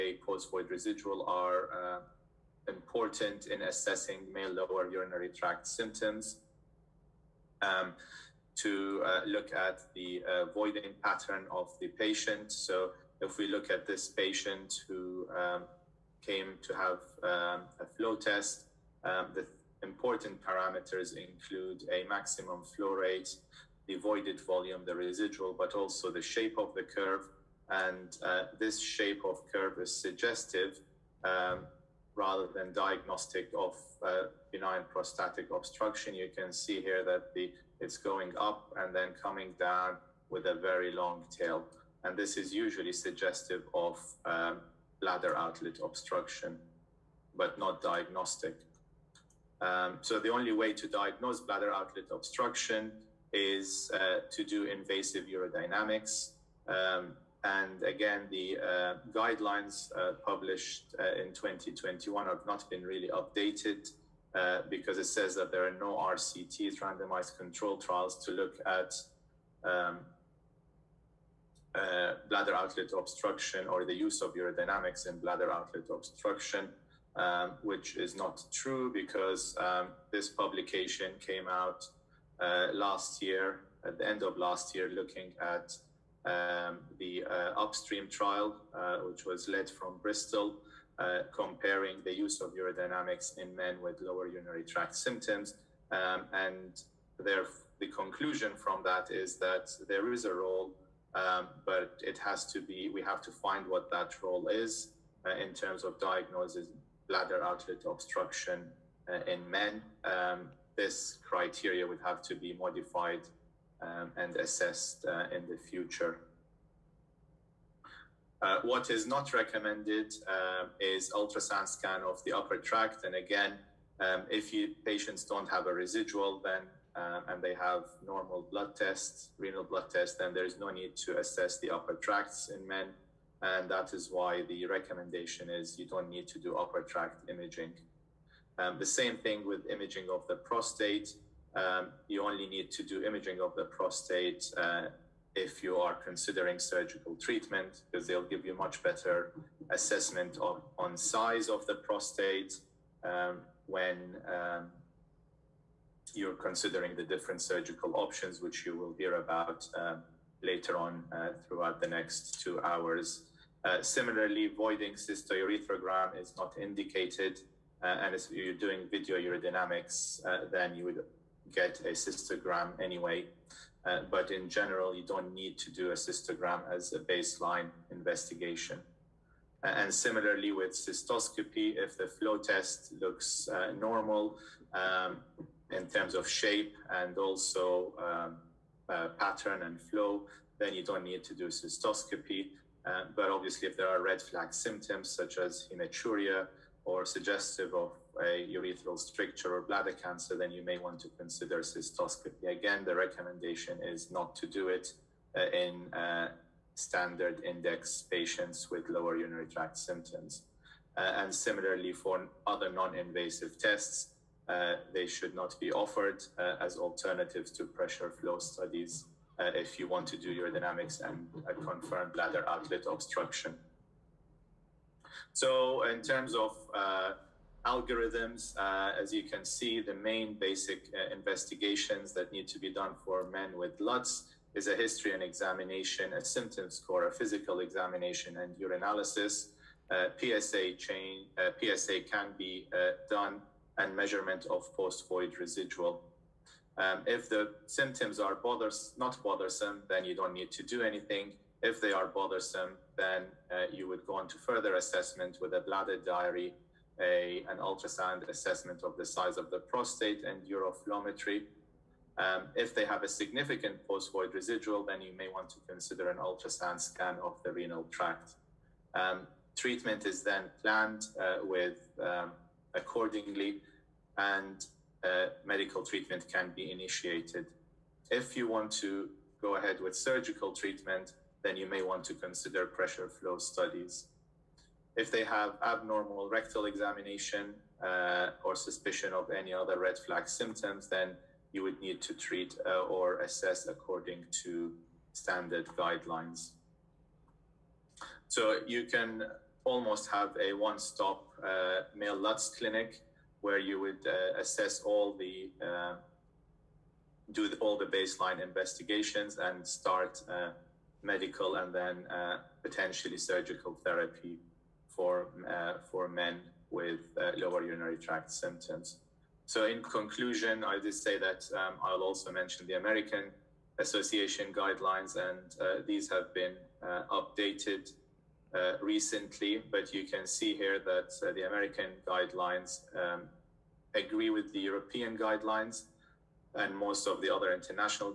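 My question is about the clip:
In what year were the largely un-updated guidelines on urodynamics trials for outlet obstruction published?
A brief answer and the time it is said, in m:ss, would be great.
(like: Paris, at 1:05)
2021, at 1:01.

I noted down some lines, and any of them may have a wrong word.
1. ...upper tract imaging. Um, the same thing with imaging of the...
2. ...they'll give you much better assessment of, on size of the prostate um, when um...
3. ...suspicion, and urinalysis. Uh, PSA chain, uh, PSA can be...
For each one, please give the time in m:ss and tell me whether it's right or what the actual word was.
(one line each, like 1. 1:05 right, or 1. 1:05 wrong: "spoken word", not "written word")
1. 2:16 right
2. 2:28 right
3. 3:57 wrong: "examination", not "suspicion".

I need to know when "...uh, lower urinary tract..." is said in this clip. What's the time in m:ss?
5:17.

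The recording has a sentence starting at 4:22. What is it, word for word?
Um, if they have a significant post void residual, then you may want to consider an ultrasound scan of the renal tract.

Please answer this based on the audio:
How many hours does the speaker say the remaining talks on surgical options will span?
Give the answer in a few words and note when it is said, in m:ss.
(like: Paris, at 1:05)
2, at 2:42.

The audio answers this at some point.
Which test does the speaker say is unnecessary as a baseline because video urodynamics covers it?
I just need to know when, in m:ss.
2:44.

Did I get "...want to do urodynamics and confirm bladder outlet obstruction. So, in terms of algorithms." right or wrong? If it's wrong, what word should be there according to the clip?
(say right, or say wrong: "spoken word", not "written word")
right.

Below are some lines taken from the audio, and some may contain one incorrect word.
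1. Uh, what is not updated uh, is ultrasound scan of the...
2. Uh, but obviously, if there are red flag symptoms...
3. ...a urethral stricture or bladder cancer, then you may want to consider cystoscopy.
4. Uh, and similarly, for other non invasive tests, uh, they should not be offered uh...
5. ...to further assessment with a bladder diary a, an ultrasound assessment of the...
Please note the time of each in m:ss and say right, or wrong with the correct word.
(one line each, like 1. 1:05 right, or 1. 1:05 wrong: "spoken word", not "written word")
1. 1:58 wrong: "recommended", not "updated"
2. 3:12 right
3. 3:18 right
4. 3:30 right
5. 4:14 right.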